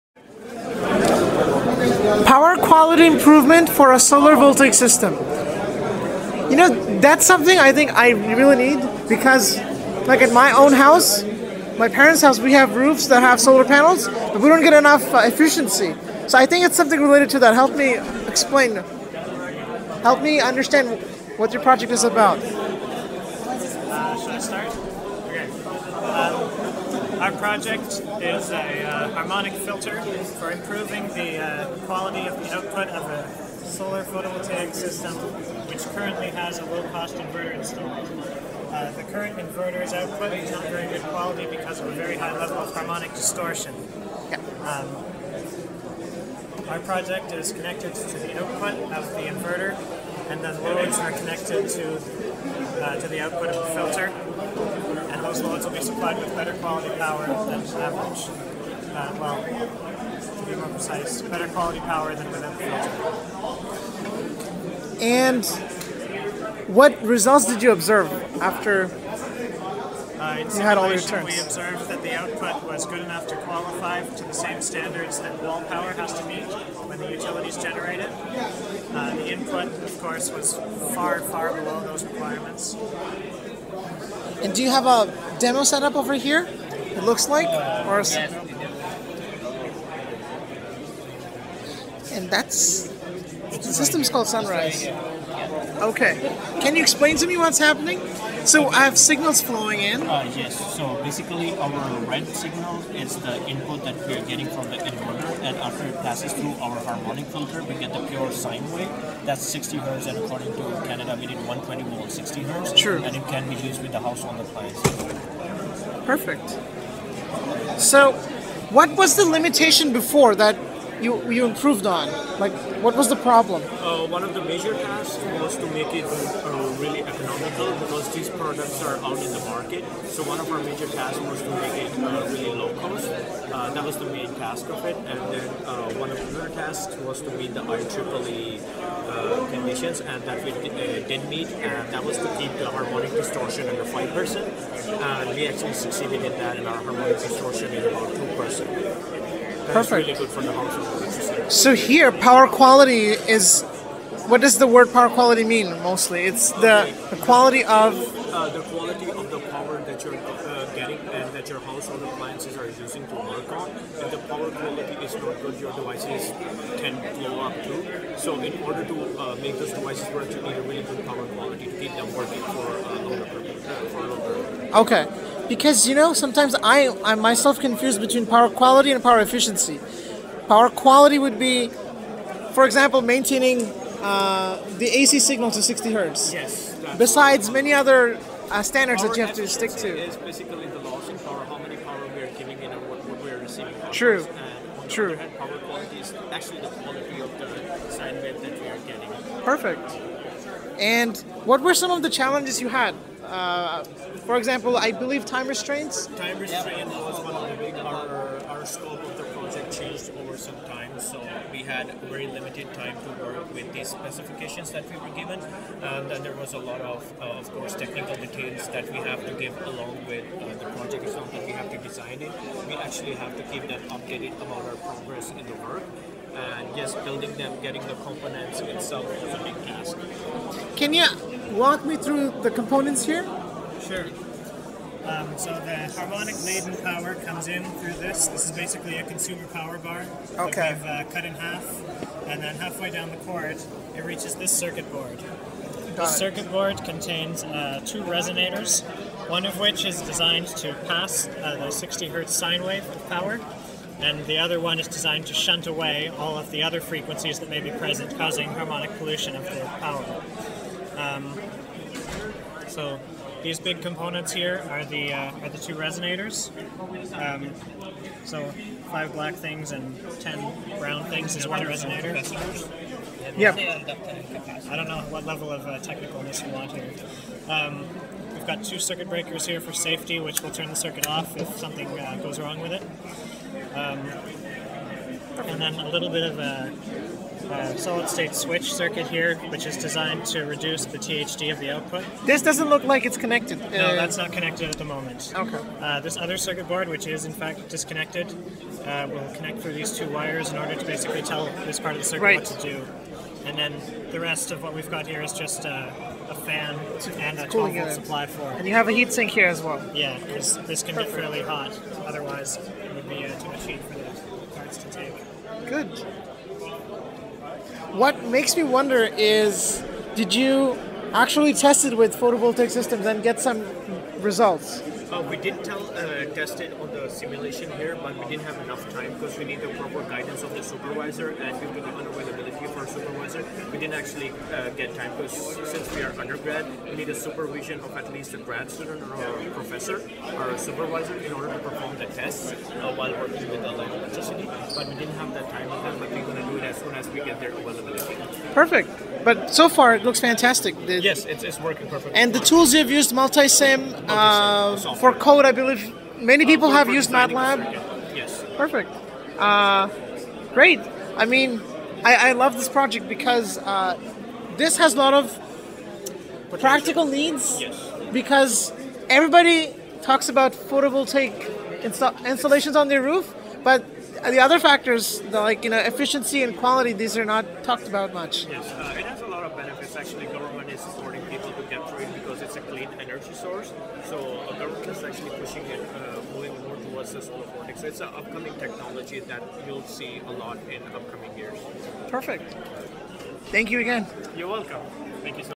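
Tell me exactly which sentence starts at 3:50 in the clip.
Can you walk me through the components here?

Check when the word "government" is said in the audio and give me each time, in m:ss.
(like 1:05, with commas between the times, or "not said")
6:20, 6:24.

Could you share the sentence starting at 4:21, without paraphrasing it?
Um, so these big components here are the uh, are the two resonators.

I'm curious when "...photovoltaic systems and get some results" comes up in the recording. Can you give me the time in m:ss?
5:22.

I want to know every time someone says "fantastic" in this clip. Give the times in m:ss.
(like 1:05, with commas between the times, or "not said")
5:50.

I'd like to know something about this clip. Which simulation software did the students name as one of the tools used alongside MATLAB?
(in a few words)
Multisim.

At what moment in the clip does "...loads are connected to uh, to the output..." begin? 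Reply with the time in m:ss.
0:50.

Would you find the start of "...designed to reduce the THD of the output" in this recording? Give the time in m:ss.
4:49.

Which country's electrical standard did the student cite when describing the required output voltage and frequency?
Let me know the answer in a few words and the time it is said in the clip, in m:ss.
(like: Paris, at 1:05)
Canada, at 1:50.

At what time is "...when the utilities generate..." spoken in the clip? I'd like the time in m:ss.
1:16.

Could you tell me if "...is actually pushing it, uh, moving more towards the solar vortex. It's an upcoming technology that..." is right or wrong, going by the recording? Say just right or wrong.
right.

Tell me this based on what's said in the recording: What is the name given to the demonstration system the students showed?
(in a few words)
Sunrise.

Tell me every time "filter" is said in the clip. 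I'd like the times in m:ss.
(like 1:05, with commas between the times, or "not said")
0:29, 0:53, 1:03, 1:47.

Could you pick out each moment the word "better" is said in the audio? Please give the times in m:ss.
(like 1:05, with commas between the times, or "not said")
0:56, 1:01.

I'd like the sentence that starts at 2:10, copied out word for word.
So one of our major tasks was to make it uh, really low cost.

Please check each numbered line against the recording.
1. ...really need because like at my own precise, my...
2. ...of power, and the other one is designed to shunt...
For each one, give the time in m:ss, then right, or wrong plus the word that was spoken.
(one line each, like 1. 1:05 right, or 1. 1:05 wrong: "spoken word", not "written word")
1. 0:08 wrong: "house", not "precise"
2. 4:12 right.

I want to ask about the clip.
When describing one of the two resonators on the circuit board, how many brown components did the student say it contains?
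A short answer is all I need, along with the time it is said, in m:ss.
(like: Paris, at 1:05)
10, at 4:30.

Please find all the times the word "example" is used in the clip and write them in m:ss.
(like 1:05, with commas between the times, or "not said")
3:02, 3:24.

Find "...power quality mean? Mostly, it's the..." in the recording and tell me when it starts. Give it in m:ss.
2:34.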